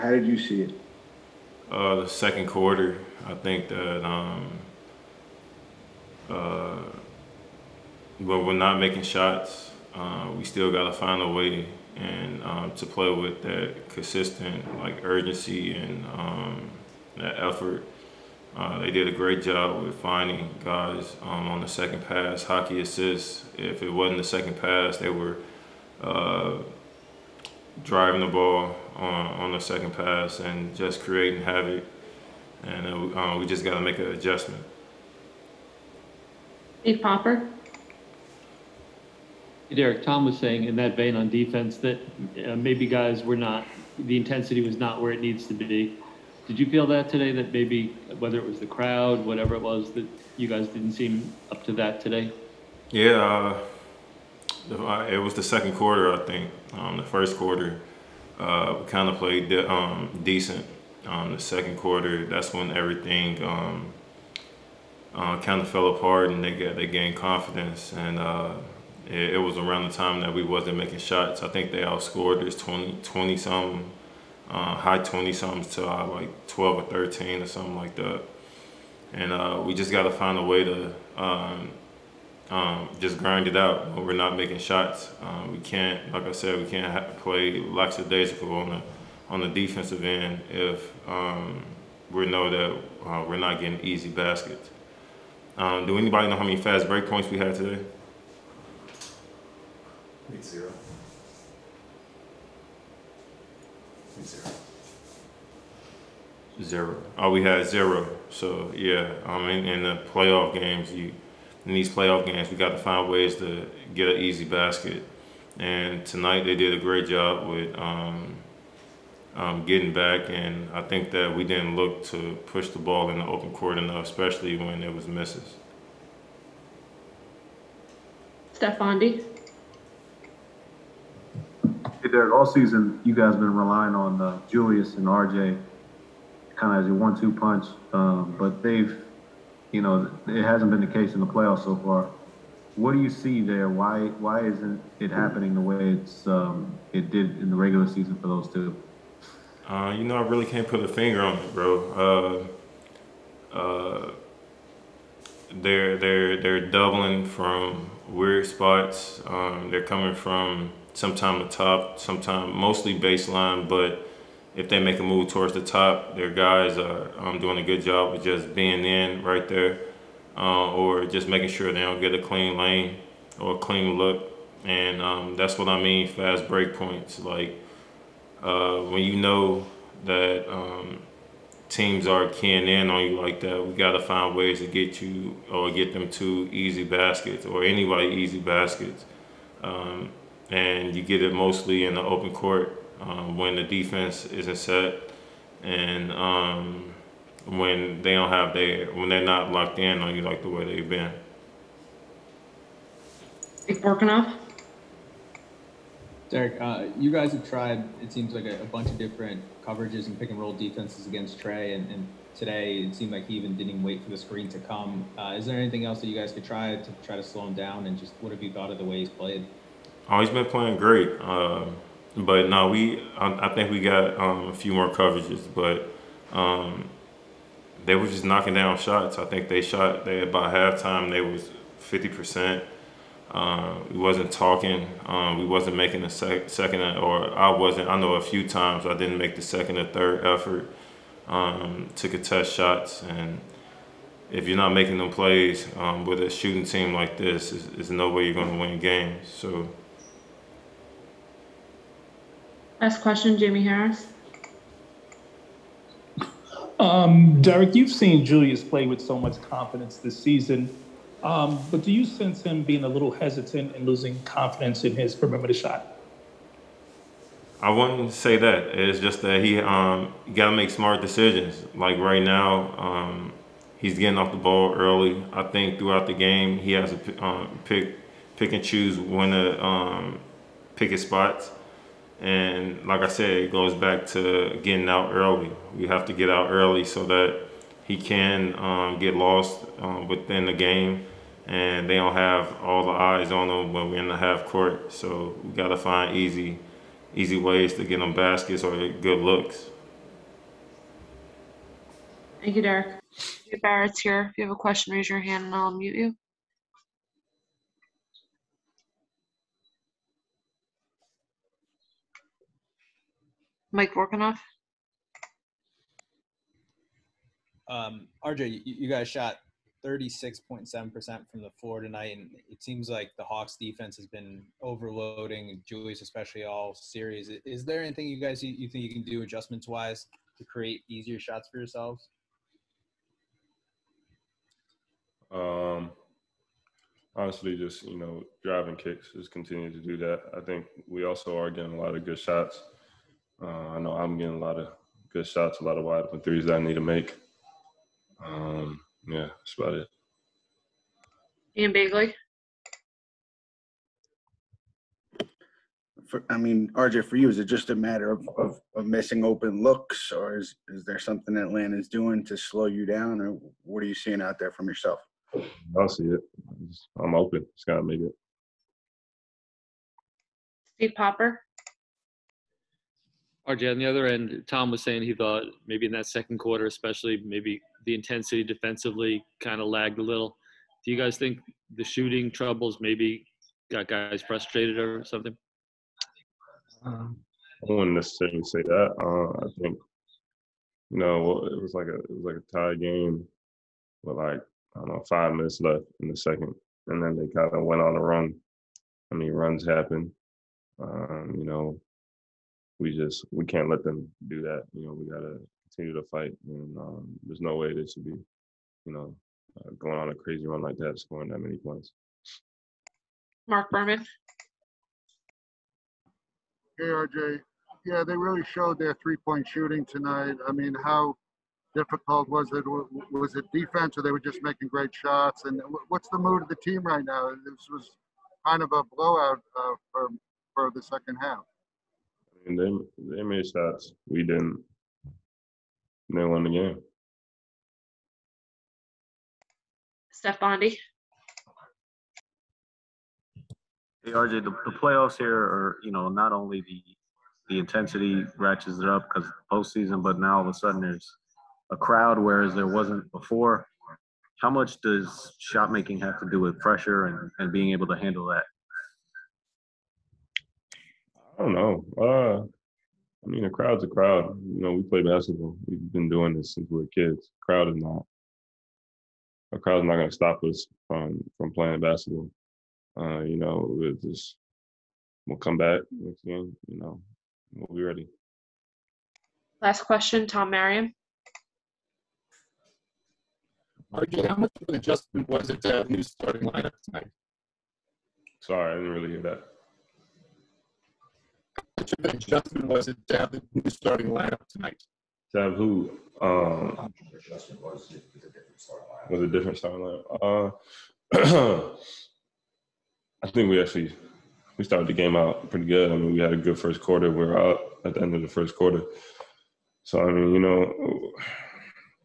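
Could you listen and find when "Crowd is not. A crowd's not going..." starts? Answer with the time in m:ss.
7:47.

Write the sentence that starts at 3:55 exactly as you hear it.
Um, we wasn't making a sec- second or I wasn't.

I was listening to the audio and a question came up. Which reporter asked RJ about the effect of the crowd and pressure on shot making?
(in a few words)
Steph Bondy.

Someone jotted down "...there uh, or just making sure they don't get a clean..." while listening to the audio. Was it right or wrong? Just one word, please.
right.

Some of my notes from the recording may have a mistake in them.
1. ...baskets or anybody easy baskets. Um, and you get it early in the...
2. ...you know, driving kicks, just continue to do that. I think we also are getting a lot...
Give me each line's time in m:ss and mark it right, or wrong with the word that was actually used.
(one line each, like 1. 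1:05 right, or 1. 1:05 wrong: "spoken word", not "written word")
1. 3:06 wrong: "mostly", not "early"
2. 5:37 right.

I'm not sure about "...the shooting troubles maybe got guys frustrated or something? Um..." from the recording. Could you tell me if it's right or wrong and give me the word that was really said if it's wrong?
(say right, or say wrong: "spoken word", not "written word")
right.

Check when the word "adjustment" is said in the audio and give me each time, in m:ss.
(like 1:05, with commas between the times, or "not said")
0:34, 5:29, 8:04, 8:12.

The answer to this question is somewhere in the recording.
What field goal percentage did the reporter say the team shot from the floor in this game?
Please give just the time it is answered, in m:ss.
5:19.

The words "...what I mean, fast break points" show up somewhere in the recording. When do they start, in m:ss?
2:55.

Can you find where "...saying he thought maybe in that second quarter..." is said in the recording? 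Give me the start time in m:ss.
6:14.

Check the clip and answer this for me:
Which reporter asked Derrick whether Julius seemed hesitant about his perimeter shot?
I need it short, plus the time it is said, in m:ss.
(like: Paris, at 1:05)
Jamie Harris, at 4:13.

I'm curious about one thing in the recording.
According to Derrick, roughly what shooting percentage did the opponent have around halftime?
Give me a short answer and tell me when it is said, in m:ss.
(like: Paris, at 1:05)
50%, at 3:51.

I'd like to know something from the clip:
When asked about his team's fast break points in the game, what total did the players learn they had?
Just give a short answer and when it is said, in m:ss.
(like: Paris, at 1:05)
0, at 1:47.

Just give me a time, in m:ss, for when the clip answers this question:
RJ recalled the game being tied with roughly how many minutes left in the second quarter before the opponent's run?
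6:35.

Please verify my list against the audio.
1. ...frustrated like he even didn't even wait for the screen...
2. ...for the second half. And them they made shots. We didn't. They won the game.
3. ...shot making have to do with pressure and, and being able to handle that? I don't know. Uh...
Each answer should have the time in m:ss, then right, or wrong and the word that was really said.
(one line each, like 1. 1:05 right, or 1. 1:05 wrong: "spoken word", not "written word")
1. 3:32 wrong: "seemed", not "frustrated"
2. 7:10 right
3. 7:35 right.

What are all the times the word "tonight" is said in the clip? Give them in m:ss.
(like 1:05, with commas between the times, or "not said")
1:56, 5:21, 6:59, 8:06, 8:14.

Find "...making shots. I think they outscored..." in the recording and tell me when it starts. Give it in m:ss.
1:10.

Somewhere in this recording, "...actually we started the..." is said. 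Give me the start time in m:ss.
8:23.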